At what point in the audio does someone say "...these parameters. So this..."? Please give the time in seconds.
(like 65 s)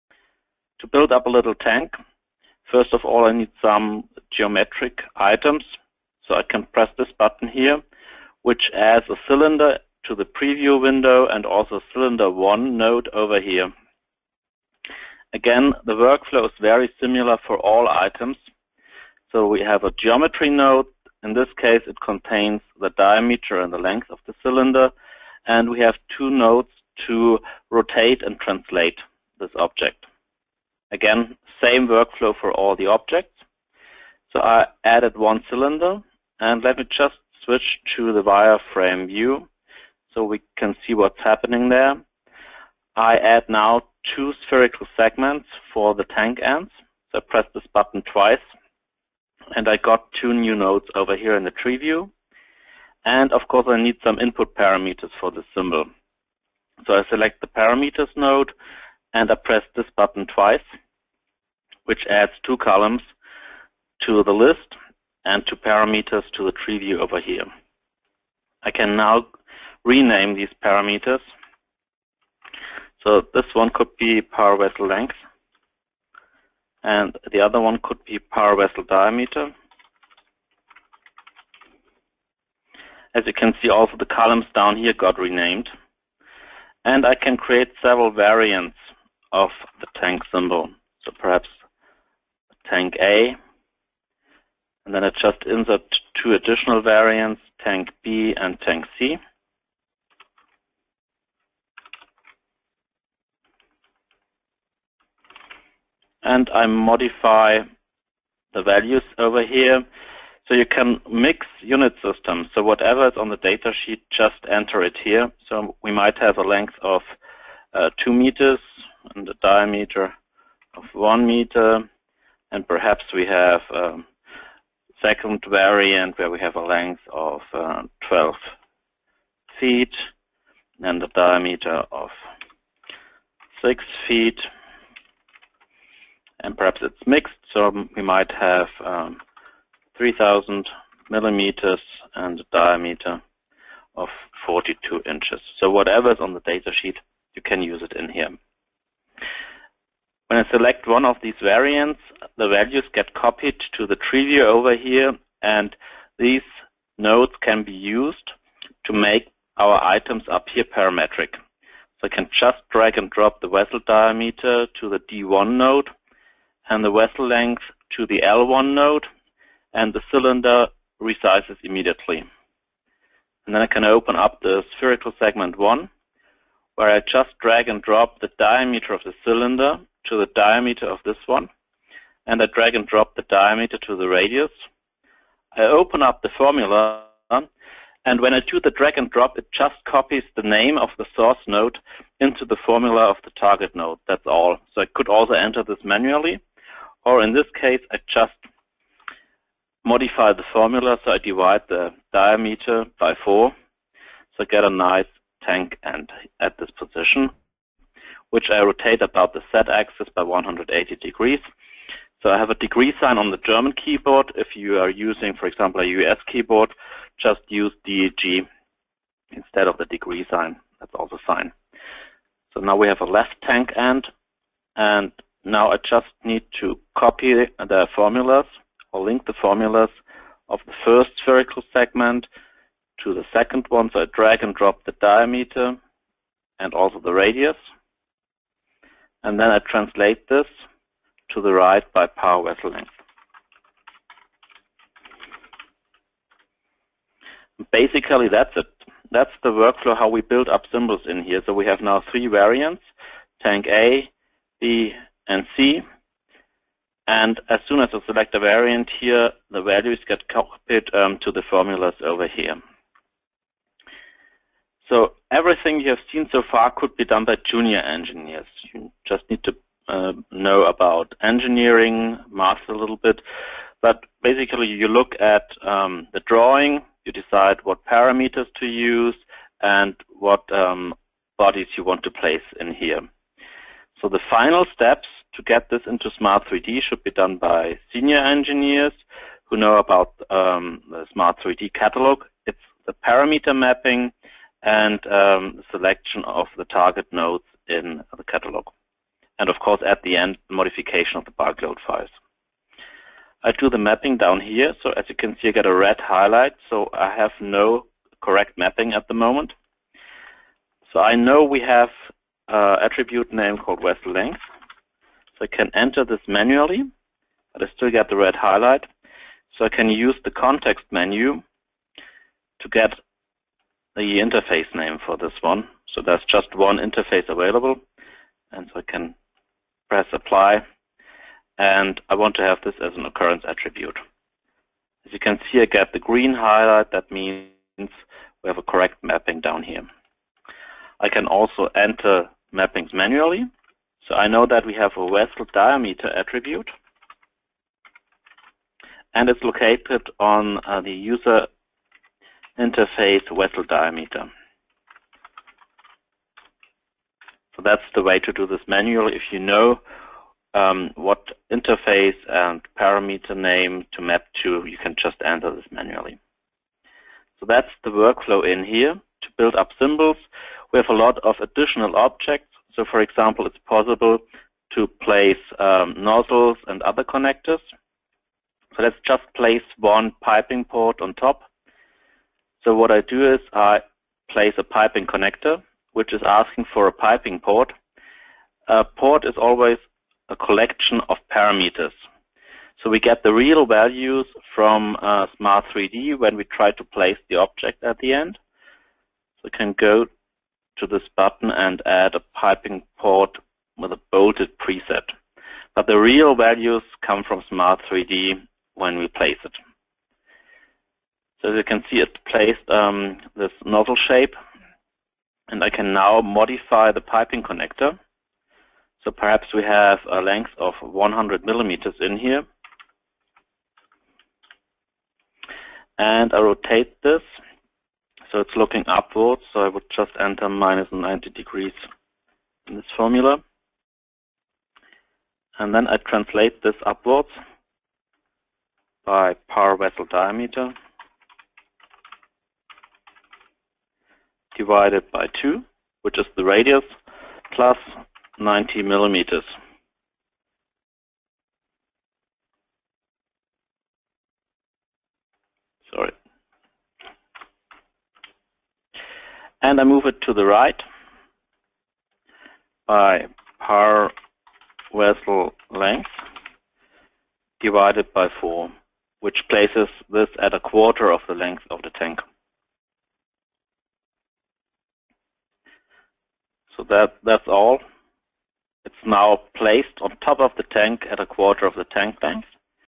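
70 s.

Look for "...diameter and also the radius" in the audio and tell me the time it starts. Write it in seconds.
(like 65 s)
235 s.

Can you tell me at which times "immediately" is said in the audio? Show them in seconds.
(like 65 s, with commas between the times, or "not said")
171 s.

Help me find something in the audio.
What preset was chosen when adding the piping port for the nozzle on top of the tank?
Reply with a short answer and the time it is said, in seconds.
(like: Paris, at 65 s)
Bolted preset, at 404 s.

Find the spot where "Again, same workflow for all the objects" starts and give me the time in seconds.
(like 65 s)
30 s.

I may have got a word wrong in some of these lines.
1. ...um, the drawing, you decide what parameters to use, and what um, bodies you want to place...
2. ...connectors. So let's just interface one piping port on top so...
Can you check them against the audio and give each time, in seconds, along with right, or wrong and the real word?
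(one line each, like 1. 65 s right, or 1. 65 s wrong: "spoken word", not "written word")
1. 275 s right
2. 377 s wrong: "place", not "interface".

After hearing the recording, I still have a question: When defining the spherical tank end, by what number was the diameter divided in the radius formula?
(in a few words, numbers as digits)
4.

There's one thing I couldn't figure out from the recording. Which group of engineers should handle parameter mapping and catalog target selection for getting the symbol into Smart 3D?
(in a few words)
Senior engineers.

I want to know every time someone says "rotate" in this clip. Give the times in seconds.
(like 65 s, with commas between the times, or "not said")
27 s, 208 s, 426 s.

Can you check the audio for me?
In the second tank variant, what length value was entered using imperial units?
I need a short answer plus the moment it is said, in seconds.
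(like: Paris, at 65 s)
12 feet, at 128 s.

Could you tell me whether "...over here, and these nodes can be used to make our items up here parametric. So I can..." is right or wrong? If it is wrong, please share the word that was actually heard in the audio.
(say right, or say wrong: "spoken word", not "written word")
right.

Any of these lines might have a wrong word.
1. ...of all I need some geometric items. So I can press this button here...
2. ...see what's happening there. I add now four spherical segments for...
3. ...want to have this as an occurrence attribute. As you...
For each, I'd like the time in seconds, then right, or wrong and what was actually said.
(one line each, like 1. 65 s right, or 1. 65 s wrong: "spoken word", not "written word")
1. 2 s right
2. 40 s wrong: "two", not "four"
3. 332 s right.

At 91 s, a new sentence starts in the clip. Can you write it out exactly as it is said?
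So perhaps tank A, and then I just insert two additional variants, tank B and tank C.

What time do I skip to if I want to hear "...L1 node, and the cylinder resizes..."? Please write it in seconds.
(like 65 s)
168 s.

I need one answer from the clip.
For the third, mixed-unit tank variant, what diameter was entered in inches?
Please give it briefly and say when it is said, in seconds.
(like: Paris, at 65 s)
42 inches, at 144 s.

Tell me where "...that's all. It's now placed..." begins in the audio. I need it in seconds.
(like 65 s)
477 s.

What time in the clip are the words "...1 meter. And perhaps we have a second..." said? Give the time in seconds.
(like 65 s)
120 s.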